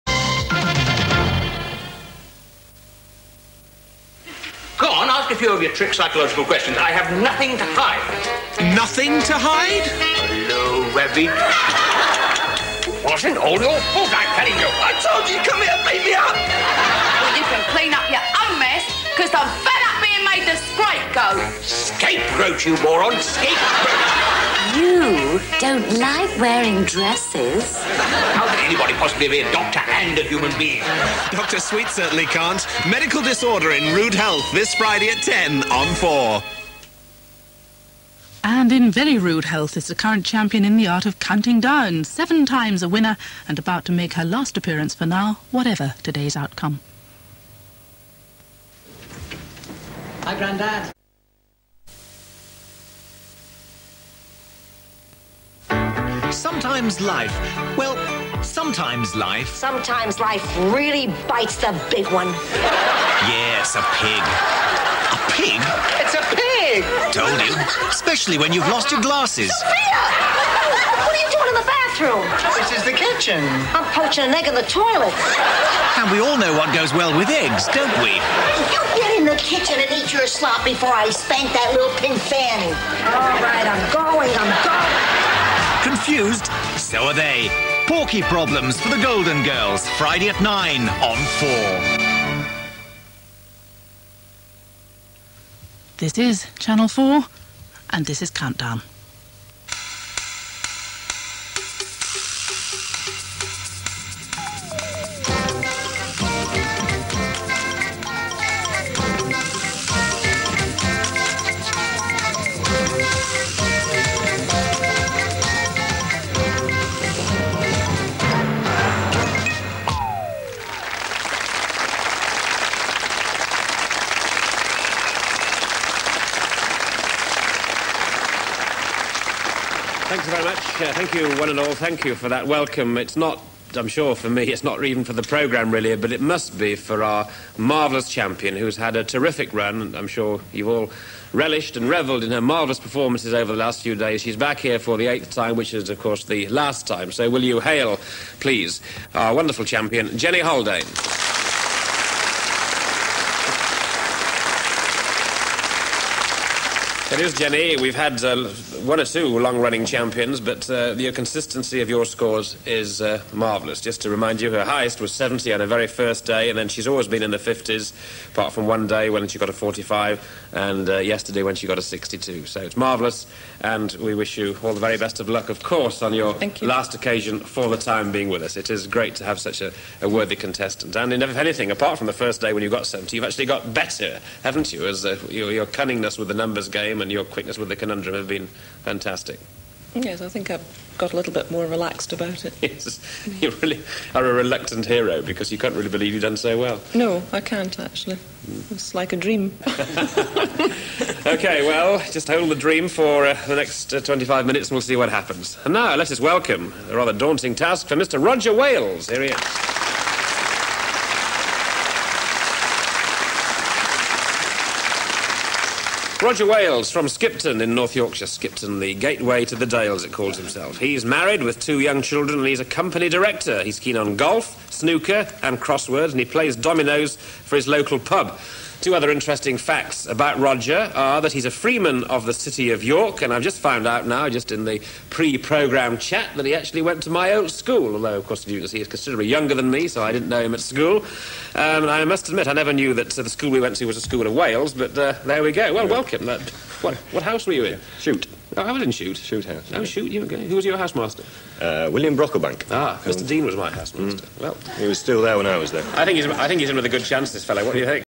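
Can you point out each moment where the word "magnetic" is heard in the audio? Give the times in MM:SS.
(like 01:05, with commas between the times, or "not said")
not said.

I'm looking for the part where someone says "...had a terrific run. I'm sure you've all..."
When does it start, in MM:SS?
02:18.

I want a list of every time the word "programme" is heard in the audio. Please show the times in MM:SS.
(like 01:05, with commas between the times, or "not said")
02:15, 03:55.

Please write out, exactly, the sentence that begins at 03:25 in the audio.
And now, let us welcome a rather daunting task for Mr.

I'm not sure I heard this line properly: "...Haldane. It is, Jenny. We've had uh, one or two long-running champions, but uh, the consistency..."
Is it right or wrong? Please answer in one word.
right.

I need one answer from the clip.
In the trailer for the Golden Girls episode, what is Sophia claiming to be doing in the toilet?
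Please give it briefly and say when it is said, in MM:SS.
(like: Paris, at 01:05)
Poaching an egg, at 01:13.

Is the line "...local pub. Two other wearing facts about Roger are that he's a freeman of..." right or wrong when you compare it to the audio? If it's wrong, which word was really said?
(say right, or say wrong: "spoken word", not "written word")
wrong: "interesting", not "wearing".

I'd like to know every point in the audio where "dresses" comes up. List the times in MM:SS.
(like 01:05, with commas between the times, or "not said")
00:26.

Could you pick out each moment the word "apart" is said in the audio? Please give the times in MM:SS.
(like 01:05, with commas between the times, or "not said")
02:48, 03:01.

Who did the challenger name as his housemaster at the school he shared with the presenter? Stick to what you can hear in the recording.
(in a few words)
William Brocklebank.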